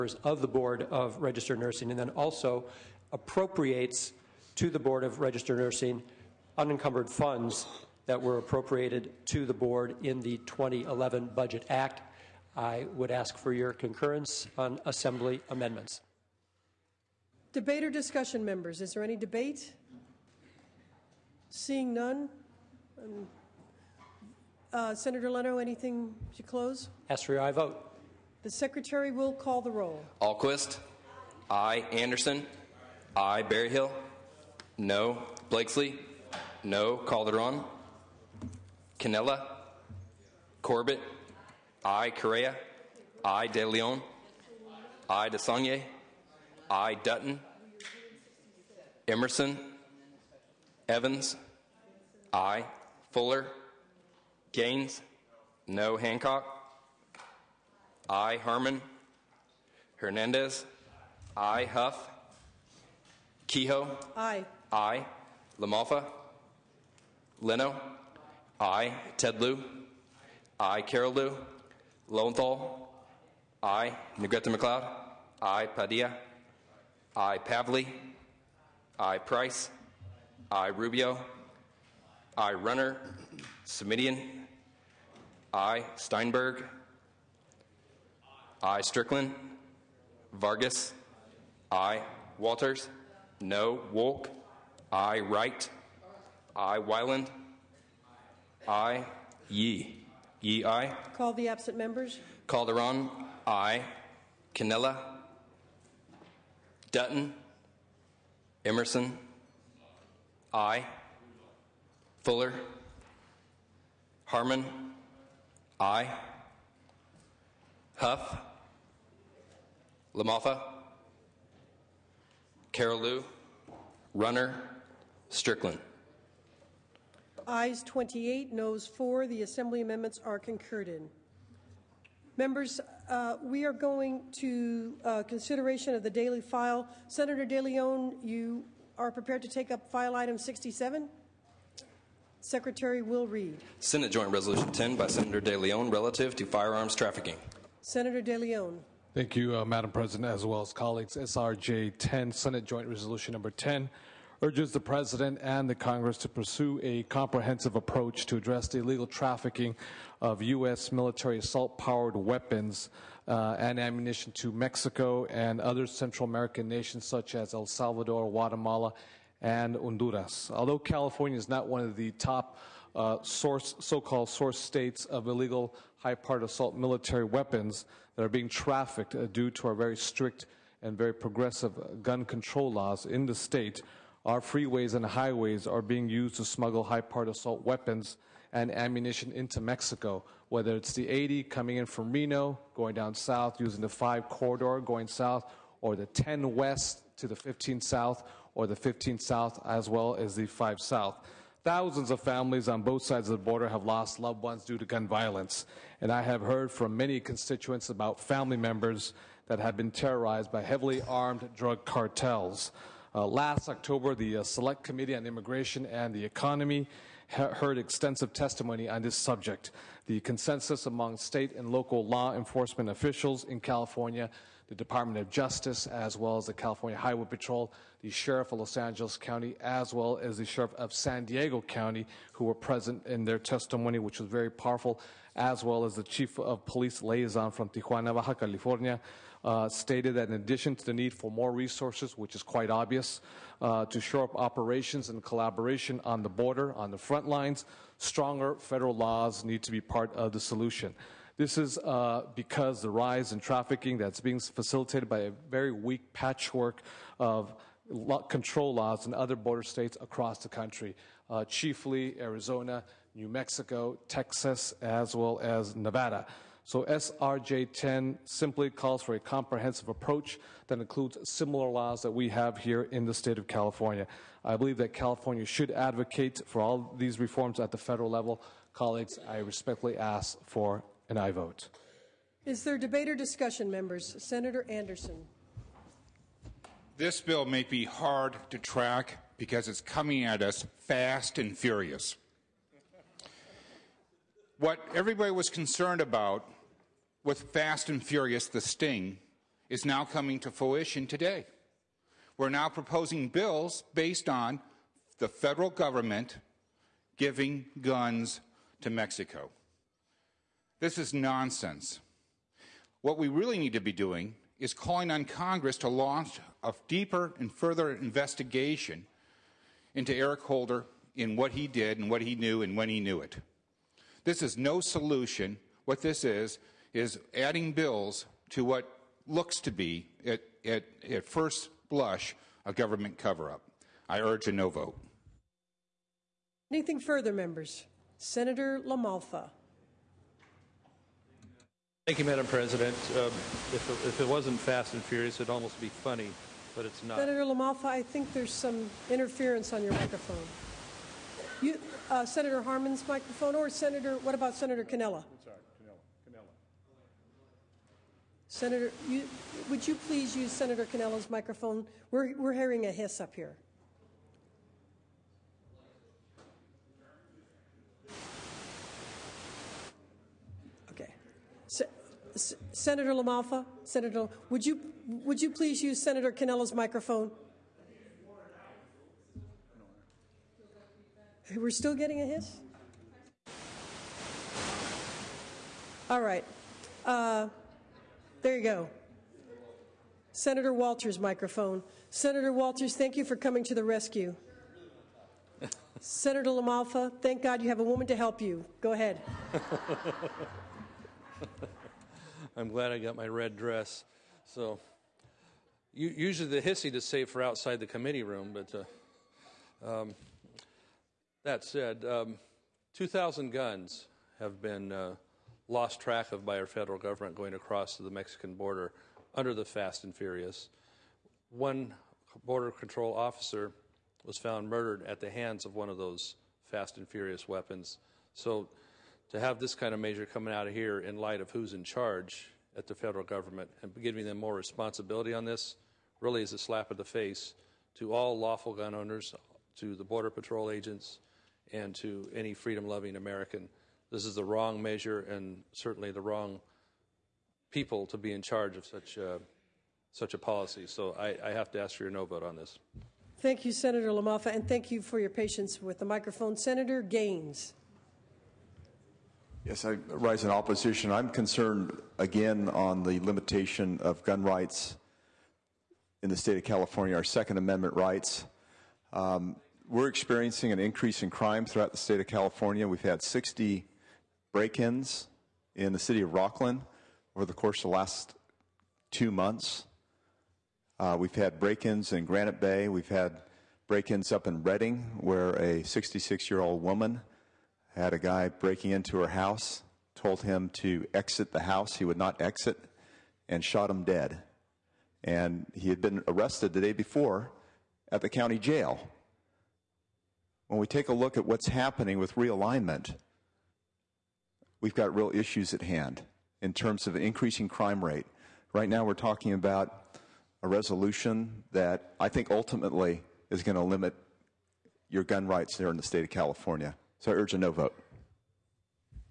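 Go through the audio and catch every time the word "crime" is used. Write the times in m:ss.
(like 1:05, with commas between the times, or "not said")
7:51, 8:27.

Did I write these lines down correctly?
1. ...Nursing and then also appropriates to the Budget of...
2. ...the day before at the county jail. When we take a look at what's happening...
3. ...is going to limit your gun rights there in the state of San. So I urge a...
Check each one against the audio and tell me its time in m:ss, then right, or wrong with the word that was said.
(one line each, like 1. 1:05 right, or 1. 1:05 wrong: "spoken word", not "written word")
1. 0:01 wrong: "Board", not "Budget"
2. 8:16 right
3. 8:33 wrong: "California", not "San".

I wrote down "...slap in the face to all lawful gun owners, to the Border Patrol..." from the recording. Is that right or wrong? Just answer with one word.
right.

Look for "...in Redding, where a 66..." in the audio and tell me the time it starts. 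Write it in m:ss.
8:04.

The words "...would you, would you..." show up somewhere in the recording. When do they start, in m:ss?
6:14.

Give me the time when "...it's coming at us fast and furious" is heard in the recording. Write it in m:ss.
4:49.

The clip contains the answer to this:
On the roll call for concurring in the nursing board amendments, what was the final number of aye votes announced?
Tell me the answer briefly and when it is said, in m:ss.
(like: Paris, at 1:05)
28, at 2:07.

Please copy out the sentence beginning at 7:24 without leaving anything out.
This is the wrong measure and certainly the wrong people to be in charge of such a, uh, such a policy.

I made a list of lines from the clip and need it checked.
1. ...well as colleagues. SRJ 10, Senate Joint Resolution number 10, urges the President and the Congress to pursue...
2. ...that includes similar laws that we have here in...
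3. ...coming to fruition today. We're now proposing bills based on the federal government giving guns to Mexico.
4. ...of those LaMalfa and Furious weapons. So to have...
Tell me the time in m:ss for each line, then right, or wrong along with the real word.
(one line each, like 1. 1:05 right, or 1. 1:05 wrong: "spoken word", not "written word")
1. 2:30 right
2. 4:30 right
3. 5:00 right
4. 7:05 wrong: "Fast", not "LaMalfa".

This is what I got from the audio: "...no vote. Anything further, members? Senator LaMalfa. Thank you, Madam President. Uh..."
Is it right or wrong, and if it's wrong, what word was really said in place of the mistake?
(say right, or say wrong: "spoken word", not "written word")
right.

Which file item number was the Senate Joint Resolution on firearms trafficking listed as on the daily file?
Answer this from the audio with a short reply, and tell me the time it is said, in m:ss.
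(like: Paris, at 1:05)
67, at 2:19.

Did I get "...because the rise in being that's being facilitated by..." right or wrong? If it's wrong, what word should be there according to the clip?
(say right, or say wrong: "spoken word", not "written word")
wrong: "trafficking", not "being".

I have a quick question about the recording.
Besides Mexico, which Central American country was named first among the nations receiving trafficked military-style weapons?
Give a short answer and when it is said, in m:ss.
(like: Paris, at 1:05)
El Salvador, at 2:47.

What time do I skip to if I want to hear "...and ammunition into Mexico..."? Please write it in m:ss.
3:08.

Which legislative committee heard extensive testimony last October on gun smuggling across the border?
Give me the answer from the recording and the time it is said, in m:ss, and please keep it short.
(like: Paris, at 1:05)
Select Committee on Immigration and the Economy, at 3:34.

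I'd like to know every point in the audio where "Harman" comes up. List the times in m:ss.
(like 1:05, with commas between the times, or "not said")
0:58, 1:54, 5:52.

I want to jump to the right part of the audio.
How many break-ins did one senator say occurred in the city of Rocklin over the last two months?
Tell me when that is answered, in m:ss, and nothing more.
7:53.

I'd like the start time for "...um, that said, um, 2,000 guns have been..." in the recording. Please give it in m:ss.
6:50.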